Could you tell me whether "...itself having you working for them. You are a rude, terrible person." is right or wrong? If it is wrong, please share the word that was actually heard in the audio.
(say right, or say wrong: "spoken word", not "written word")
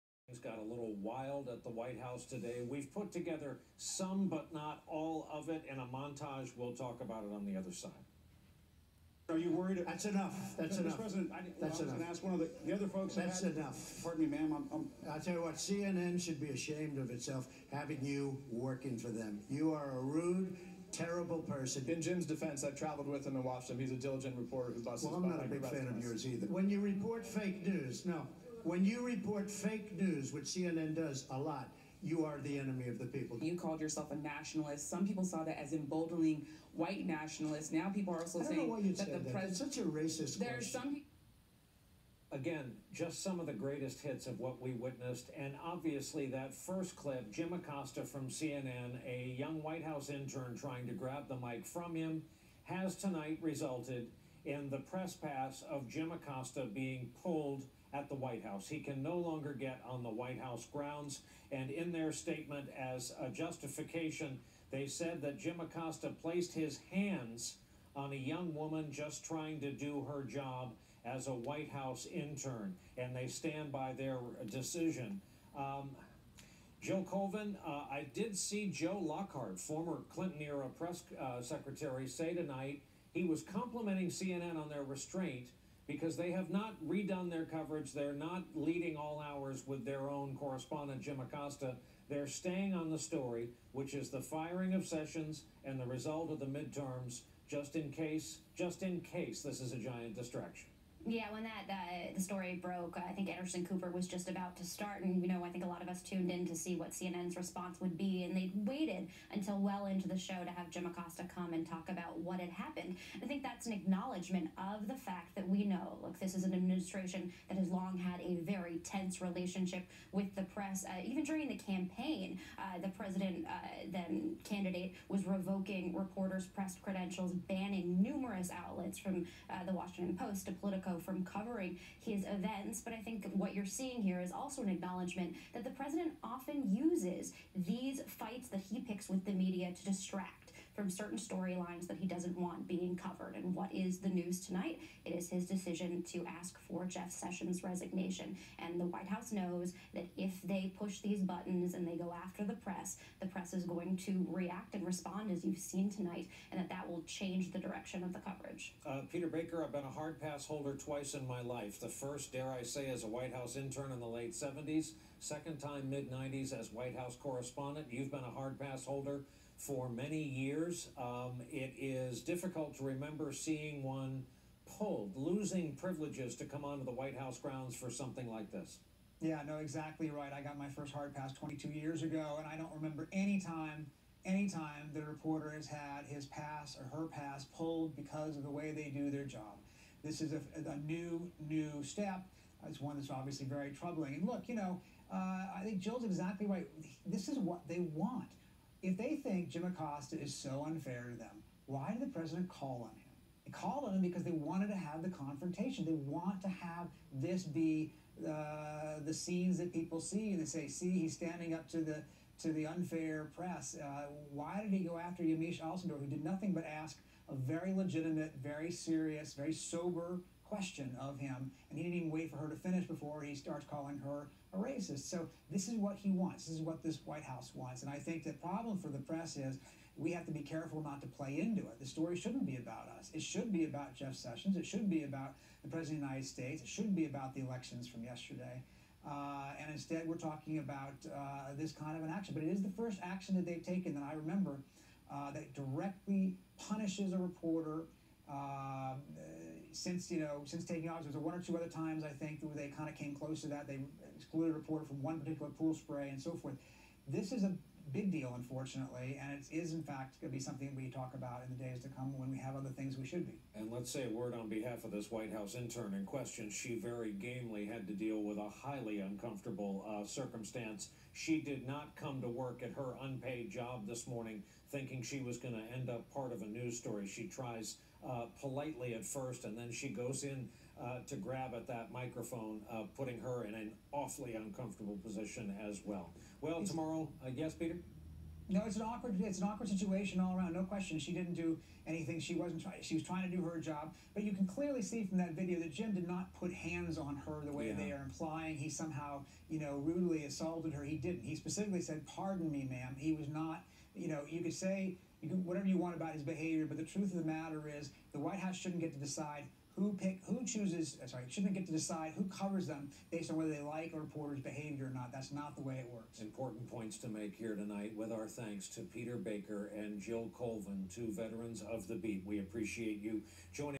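right.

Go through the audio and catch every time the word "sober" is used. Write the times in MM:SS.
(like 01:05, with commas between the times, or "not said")
03:39.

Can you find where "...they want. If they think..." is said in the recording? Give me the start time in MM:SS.
03:17.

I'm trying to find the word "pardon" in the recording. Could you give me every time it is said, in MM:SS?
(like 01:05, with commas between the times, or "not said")
00:14, 05:02.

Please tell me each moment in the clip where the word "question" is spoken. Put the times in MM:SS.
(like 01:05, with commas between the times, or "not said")
00:40, 03:40, 04:26, 04:50.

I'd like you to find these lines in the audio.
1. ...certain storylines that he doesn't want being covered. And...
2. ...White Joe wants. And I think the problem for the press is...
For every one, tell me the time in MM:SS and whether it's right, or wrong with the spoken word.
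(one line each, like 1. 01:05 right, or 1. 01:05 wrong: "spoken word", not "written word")
1. 02:20 right
2. 03:47 wrong: "House", not "Joe".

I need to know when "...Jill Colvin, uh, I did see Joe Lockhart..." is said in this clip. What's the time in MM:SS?
01:16.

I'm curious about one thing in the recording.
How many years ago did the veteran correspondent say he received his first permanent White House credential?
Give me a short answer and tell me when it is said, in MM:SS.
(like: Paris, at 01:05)
22, at 03:01.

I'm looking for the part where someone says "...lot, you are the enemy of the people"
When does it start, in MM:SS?
00:31.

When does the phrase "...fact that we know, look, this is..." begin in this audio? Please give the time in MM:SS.
01:54.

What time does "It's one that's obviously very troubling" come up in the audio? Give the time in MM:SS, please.
03:12.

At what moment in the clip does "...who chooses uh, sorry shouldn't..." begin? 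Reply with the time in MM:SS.
05:10.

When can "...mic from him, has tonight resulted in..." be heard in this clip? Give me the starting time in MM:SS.
00:51.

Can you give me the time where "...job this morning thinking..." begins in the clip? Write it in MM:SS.
04:33.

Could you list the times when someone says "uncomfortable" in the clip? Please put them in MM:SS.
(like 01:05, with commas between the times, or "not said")
04:28, 04:44.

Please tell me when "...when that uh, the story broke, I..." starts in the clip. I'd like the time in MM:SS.
01:41.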